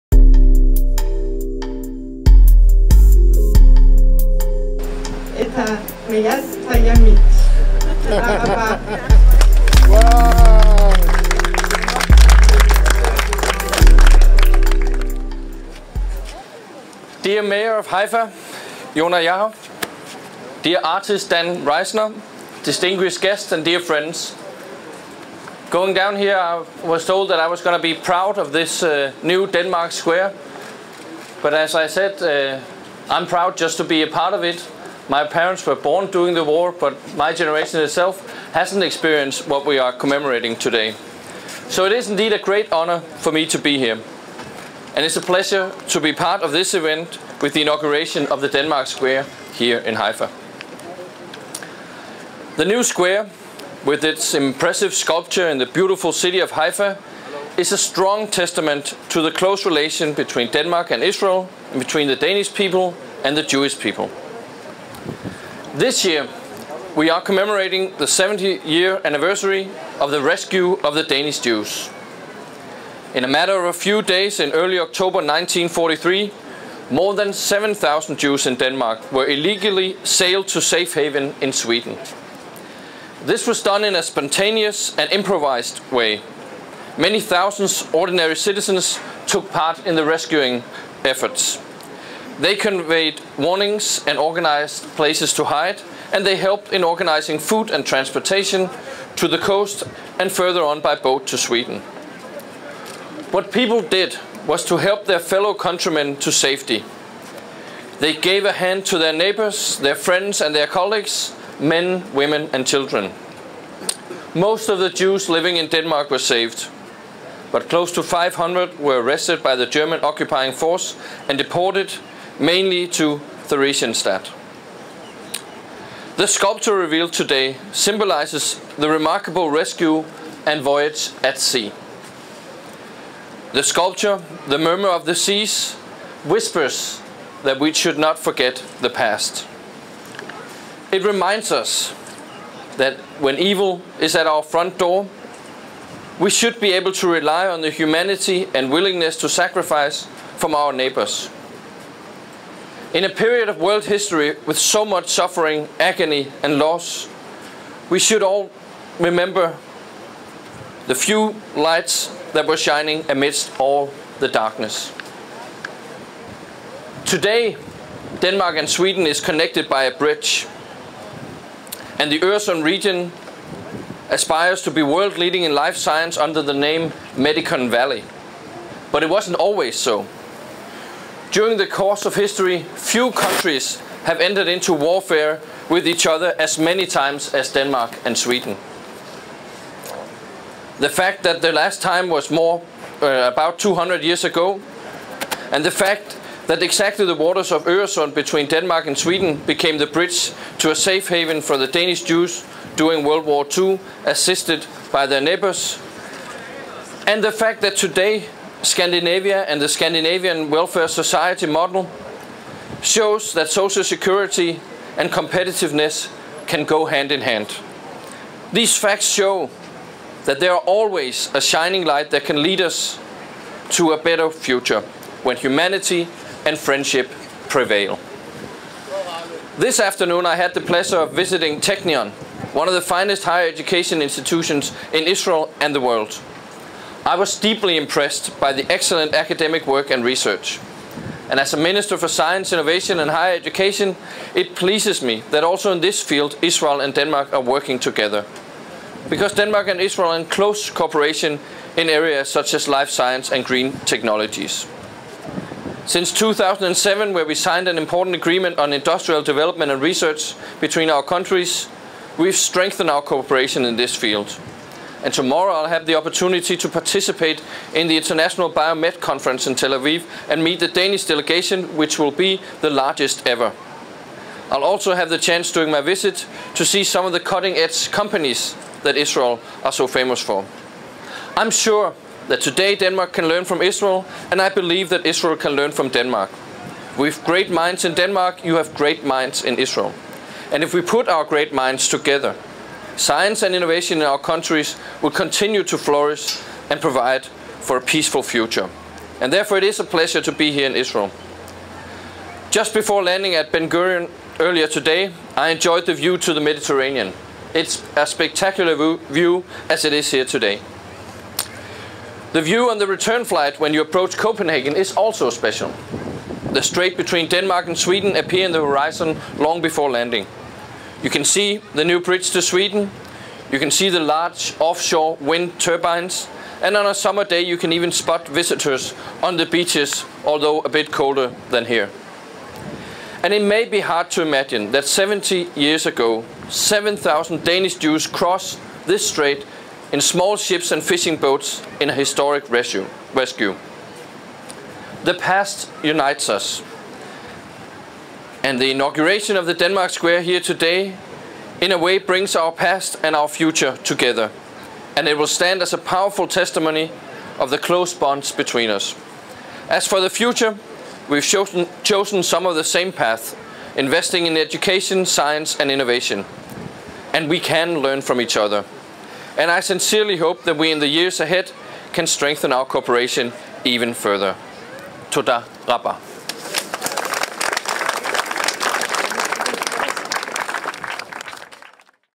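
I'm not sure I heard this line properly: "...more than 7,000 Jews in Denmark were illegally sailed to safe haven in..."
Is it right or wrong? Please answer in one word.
right.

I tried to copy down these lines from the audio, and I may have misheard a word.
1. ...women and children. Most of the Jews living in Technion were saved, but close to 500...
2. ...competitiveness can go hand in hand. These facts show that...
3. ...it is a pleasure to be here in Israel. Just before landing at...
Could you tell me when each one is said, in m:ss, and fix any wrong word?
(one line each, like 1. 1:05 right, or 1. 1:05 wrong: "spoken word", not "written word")
1. 1:52 wrong: "Denmark", not "Technion"
2. 3:35 right
3. 4:59 right.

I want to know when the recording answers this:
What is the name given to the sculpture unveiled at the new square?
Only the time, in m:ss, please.
2:14.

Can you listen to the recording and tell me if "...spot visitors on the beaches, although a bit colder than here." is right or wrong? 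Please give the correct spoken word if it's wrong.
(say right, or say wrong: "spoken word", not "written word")
right.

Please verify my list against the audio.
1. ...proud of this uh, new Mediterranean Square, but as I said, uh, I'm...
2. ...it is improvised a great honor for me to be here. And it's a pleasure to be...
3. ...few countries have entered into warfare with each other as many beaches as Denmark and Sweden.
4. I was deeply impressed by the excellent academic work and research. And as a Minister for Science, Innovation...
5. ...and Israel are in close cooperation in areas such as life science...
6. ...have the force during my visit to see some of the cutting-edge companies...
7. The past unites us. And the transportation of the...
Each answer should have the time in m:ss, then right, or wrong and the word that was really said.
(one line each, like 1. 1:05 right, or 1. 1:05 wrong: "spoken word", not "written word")
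1. 0:27 wrong: "Denmark", not "Mediterranean"
2. 0:41 wrong: "indeed", not "improvised"
3. 3:02 wrong: "times", not "beaches"
4. 3:57 right
5. 4:09 right
6. 4:34 wrong: "chance", not "force"
7. 5:45 wrong: "inauguration", not "transportation".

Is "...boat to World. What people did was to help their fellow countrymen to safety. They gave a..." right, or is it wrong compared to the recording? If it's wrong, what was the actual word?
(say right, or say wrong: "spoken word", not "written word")
wrong: "Sweden", not "World".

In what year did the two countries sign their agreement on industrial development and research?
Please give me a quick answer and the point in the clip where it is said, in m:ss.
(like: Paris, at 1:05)
2007, at 4:16.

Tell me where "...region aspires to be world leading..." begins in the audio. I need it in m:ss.
2:52.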